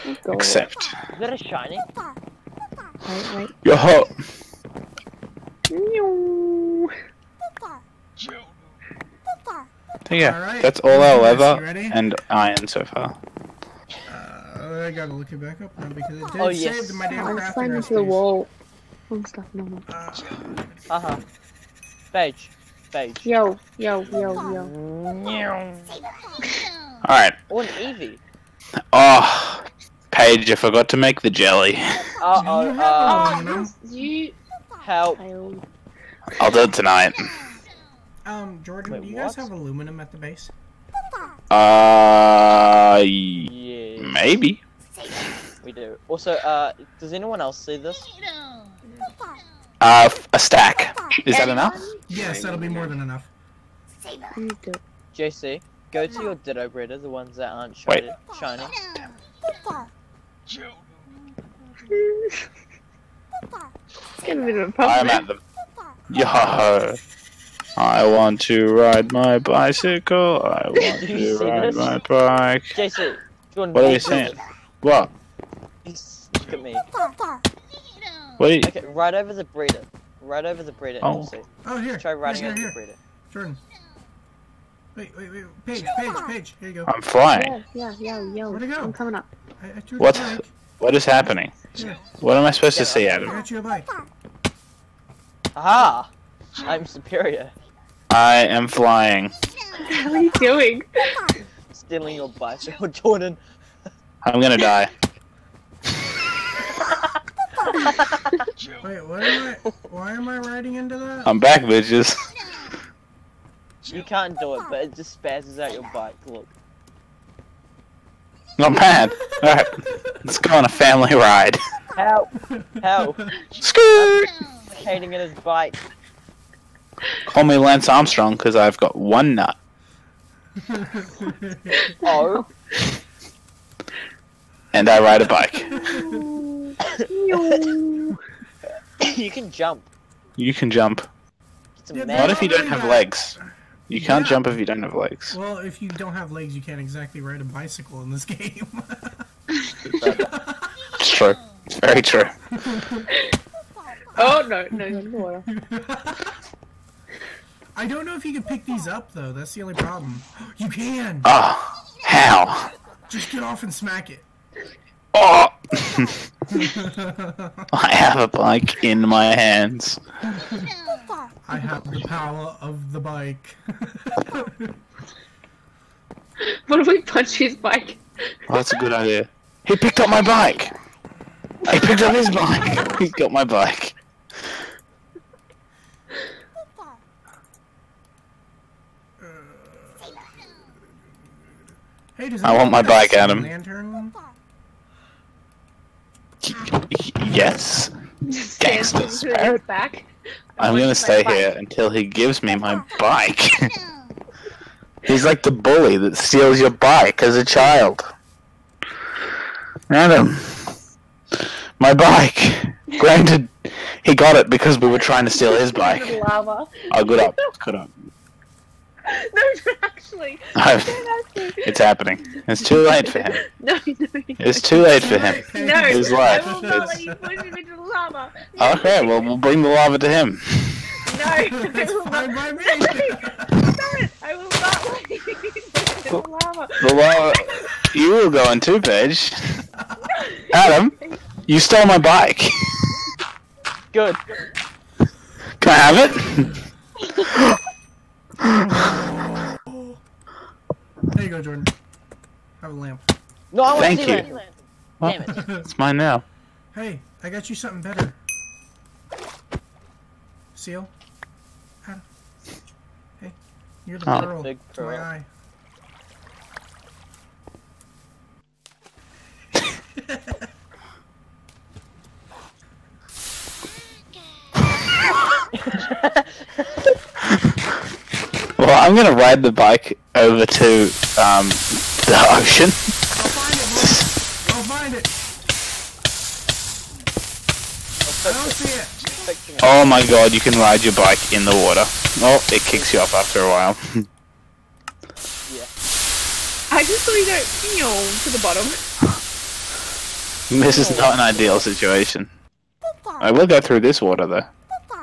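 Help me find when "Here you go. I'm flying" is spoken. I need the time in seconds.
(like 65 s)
86 s.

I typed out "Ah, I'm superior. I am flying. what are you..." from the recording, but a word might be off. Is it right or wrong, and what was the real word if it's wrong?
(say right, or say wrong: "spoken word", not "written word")
right.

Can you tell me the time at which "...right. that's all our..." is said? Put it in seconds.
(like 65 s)
10 s.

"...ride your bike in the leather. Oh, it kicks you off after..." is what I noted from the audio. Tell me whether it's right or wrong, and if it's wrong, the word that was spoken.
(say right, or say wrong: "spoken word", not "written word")
wrong: "water", not "leather".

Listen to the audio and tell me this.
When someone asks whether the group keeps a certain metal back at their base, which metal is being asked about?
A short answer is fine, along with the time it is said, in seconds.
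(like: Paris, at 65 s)
Aluminum, at 39 s.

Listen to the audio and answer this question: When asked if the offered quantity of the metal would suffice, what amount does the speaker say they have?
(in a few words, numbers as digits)
A stack.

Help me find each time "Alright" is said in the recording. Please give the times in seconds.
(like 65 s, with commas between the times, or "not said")
27 s, 119 s.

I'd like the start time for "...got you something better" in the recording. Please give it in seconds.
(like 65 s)
257 s.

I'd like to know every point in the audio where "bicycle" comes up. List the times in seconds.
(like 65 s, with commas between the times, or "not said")
69 s, 102 s, 147 s.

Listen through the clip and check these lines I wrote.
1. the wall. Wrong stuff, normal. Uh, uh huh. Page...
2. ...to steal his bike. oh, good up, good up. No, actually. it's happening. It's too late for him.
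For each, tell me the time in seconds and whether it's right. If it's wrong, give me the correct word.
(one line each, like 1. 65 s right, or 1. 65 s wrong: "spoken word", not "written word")
1. 17 s right
2. 215 s right.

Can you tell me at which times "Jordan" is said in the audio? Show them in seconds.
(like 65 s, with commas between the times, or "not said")
38 s, 83 s, 102 s, 251 s.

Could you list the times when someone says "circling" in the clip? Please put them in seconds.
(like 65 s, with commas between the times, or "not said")
not said.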